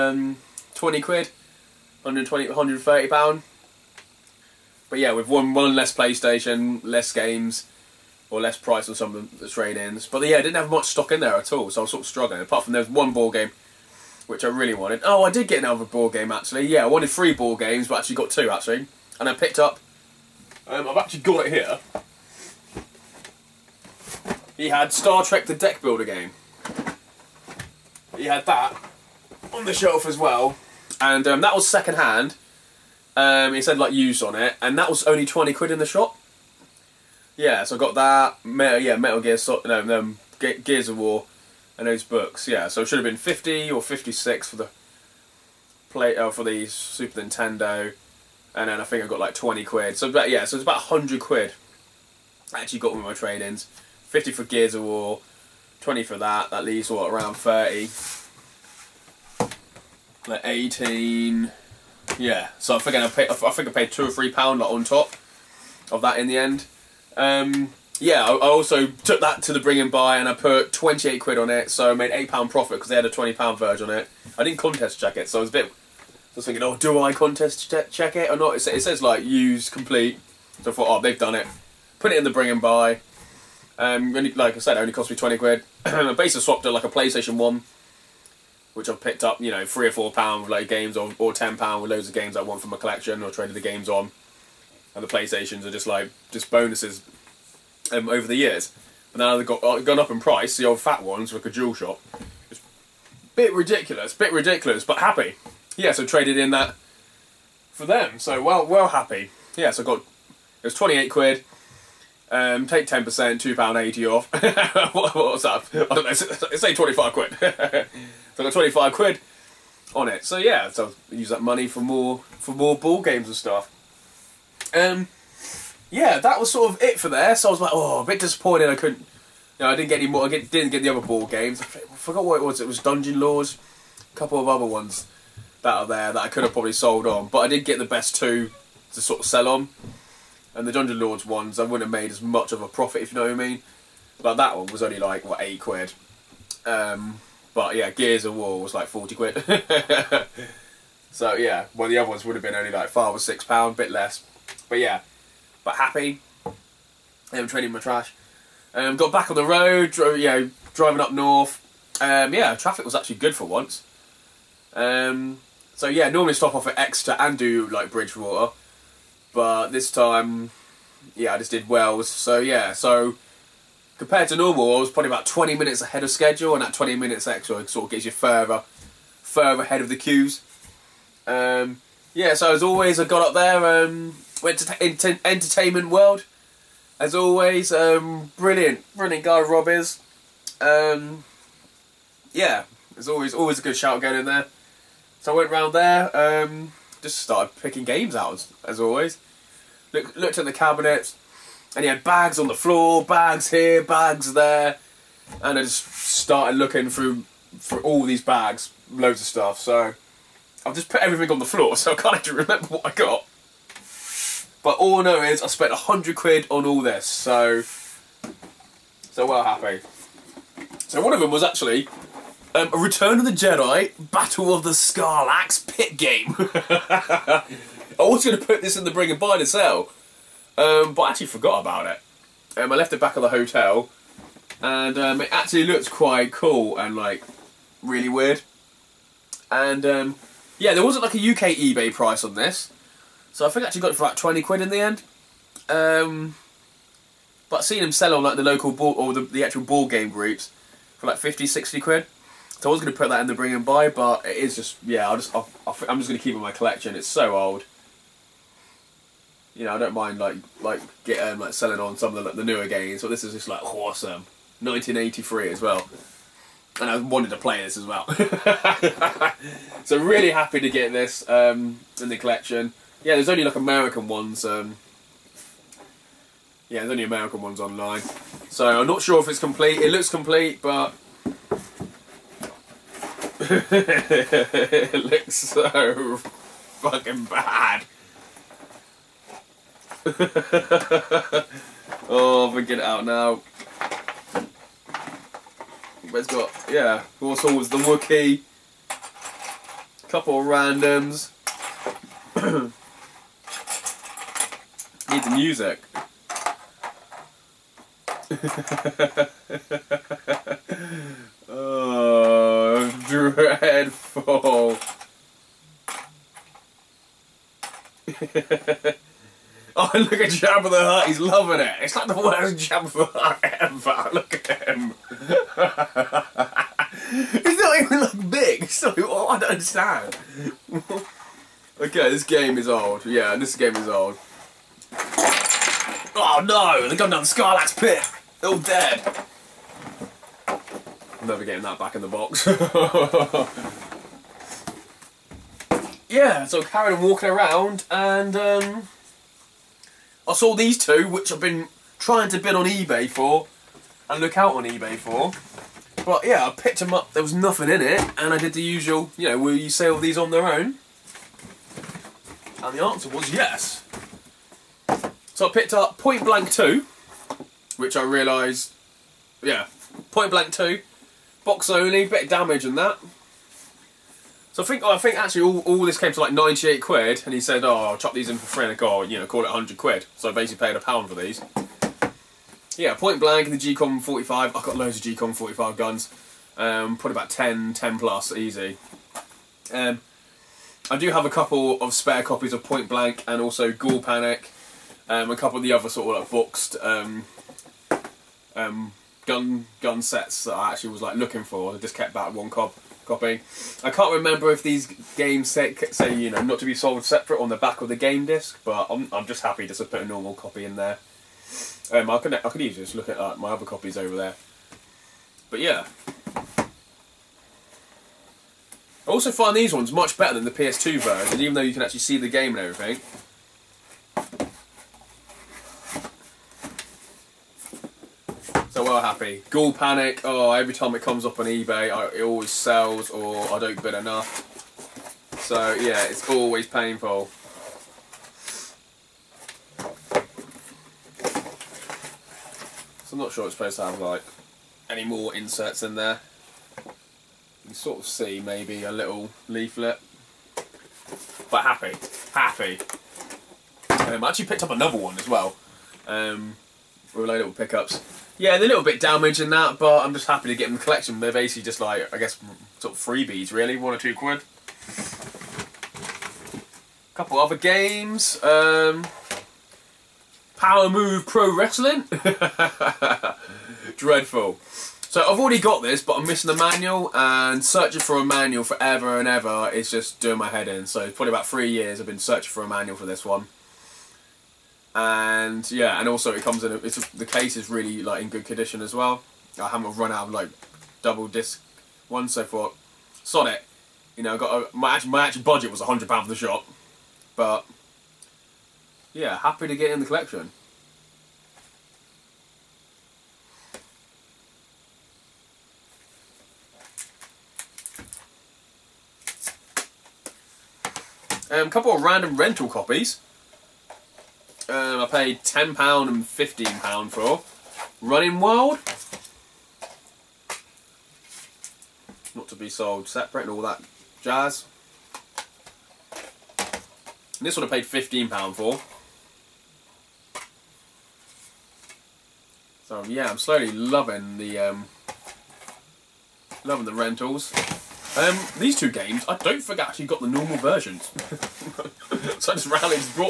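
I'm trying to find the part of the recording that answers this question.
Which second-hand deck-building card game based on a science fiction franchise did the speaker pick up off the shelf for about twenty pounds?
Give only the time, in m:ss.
0:24.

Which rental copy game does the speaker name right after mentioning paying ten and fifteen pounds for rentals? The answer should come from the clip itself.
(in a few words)
Running Wild.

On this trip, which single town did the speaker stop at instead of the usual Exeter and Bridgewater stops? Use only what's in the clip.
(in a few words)
Wells.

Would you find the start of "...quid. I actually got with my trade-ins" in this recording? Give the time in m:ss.
0:51.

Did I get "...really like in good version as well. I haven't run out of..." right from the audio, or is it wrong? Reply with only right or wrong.
wrong.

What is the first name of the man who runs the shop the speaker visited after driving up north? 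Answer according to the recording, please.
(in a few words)
Rob.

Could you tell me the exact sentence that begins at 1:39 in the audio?
But now they've got, uh, gone up in price.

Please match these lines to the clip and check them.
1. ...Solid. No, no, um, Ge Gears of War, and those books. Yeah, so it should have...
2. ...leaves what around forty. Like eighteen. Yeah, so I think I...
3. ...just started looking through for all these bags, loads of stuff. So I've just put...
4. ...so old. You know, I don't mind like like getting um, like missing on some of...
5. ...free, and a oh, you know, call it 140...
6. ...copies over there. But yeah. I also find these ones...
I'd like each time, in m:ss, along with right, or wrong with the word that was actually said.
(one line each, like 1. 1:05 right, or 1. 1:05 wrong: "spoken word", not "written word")
1. 0:39 right
2. 0:56 wrong: "thirty", not "forty"
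3. 3:25 right
4. 4:17 wrong: "selling", not "missing"
5. 6:18 wrong: "100", not "140"
6. 6:53 right.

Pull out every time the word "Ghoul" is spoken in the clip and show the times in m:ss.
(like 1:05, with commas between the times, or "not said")
6:33, 7:09.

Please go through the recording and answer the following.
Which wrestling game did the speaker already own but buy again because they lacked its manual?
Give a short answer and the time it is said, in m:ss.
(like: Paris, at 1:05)
Power Move Pro Wrestling, at 7:50.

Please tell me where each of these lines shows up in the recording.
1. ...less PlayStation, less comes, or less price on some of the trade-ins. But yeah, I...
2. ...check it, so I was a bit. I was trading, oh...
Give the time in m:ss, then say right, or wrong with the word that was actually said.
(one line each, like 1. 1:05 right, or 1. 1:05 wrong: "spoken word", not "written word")
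1. 0:05 wrong: "games", not "comes"
2. 1:14 wrong: "thinking", not "trading".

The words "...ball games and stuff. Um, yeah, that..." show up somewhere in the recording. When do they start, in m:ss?
2:02.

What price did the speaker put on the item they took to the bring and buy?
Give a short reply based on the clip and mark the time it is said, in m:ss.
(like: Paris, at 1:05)
£28, at 1:10.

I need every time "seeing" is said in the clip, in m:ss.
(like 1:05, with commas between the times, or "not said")
4:07.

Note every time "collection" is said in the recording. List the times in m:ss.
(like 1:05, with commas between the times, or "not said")
1:32, 4:16, 4:32, 7:40, 8:20.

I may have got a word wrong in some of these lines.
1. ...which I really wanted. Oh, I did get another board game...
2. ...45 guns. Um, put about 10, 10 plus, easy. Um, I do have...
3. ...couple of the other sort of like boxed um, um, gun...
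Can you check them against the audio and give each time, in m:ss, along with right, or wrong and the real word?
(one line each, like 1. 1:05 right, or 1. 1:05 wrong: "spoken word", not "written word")
1. 0:14 right
2. 6:25 right
3. 6:35 right.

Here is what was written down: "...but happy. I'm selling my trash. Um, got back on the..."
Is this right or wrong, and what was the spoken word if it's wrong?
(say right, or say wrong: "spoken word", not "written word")
wrong: "trading", not "selling".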